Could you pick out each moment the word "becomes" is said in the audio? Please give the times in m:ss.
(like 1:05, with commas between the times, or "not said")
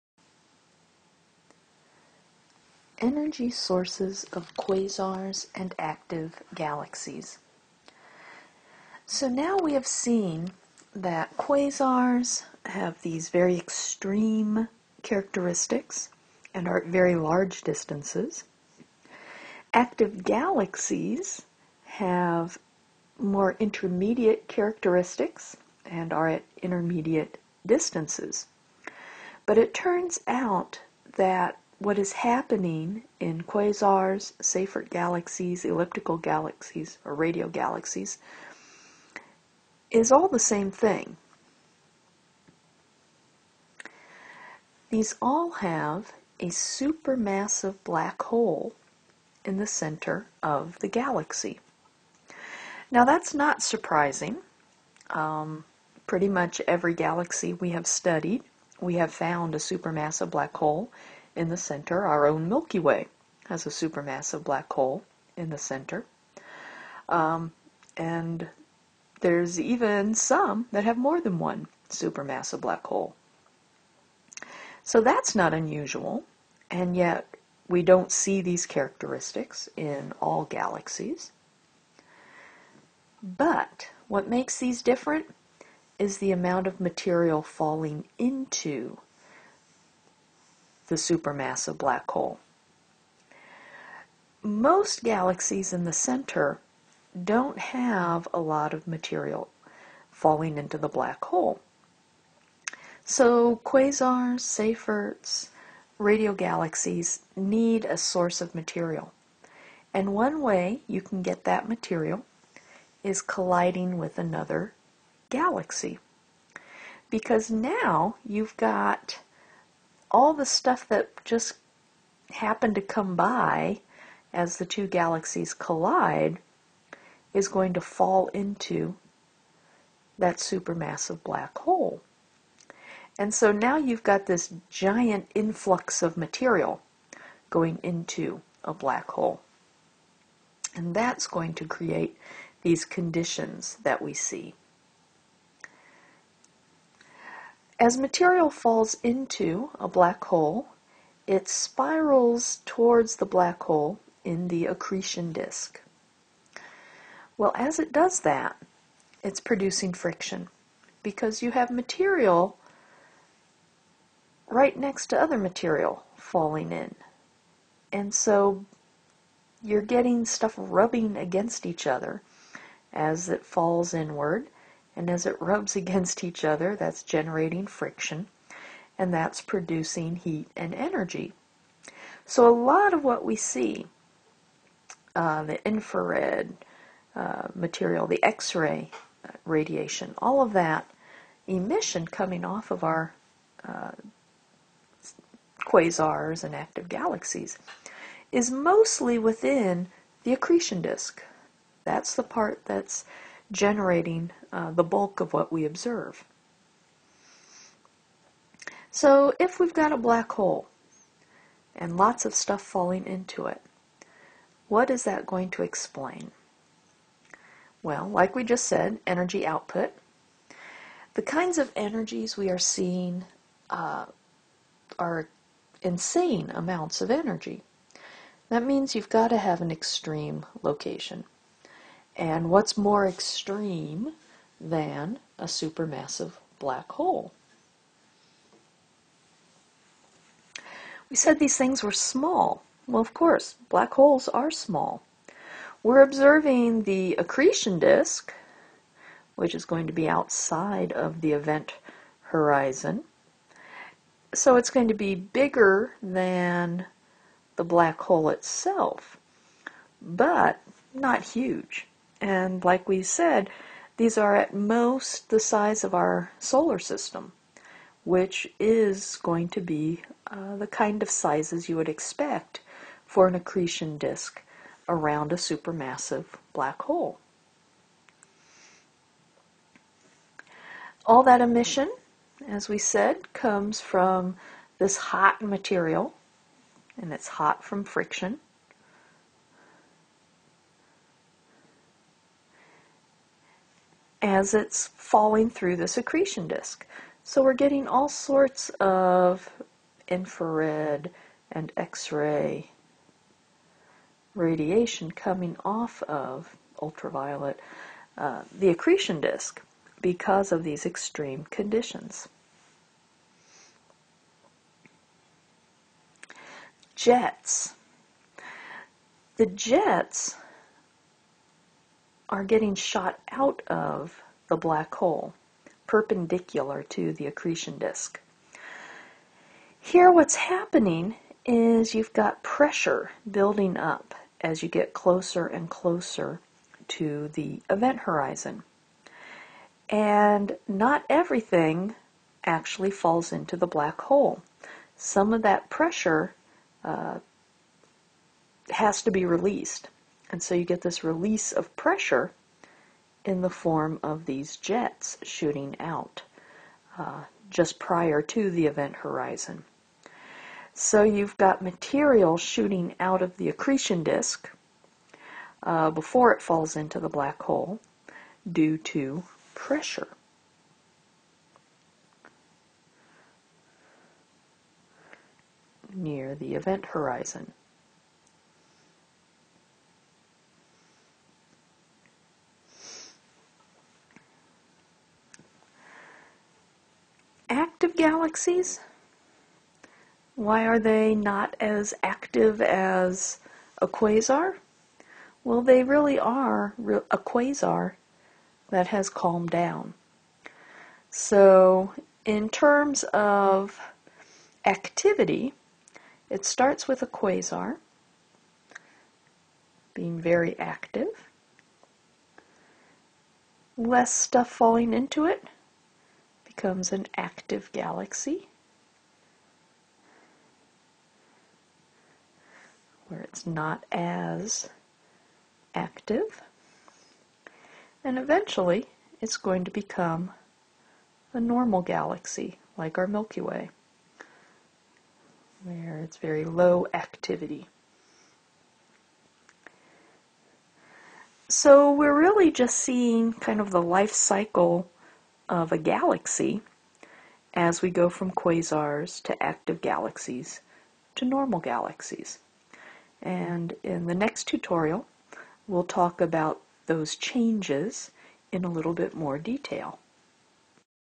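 6:56, 7:09.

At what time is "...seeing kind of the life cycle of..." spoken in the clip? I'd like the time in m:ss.
7:22.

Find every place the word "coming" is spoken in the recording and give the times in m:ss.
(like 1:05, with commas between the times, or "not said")
3:12, 5:05.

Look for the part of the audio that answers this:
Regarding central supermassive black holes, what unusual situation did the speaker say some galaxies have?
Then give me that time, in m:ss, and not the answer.
1:10.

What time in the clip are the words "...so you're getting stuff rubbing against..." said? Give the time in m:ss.
2:48.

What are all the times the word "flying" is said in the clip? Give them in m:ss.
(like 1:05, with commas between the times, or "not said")
not said.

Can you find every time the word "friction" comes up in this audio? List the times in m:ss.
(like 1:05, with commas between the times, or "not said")
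2:39, 2:57, 4:47.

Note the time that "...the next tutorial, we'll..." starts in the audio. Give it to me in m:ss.
7:34.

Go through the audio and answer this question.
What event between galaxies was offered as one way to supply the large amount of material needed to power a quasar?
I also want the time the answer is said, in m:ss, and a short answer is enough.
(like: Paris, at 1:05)
Colliding with another galaxy, at 1:53.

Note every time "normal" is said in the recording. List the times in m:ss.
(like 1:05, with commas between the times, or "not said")
7:11, 7:31.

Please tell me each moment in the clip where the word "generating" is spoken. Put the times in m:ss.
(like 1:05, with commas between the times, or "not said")
2:57, 3:23.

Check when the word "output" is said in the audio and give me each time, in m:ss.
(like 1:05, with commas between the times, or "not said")
3:39.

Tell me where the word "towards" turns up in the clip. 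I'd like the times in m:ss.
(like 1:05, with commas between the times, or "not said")
2:32.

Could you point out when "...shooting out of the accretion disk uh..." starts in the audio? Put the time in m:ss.
6:02.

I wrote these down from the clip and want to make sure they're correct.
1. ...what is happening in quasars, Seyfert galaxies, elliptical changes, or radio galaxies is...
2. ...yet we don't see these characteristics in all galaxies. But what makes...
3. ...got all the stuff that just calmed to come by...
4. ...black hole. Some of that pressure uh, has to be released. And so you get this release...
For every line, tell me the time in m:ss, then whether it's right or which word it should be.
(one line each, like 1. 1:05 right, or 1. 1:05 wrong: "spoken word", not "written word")
1. 0:31 wrong: "galaxies", not "changes"
2. 1:16 right
3. 1:58 wrong: "happened", not "calmed"
4. 5:43 right.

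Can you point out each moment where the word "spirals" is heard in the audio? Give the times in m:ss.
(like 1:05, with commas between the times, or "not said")
2:31.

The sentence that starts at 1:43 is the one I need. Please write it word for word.
So quasars, Seyferts, radio galaxies need a source of material.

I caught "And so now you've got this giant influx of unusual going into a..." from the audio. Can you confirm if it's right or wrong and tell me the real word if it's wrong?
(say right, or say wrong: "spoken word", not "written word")
wrong: "material", not "unusual".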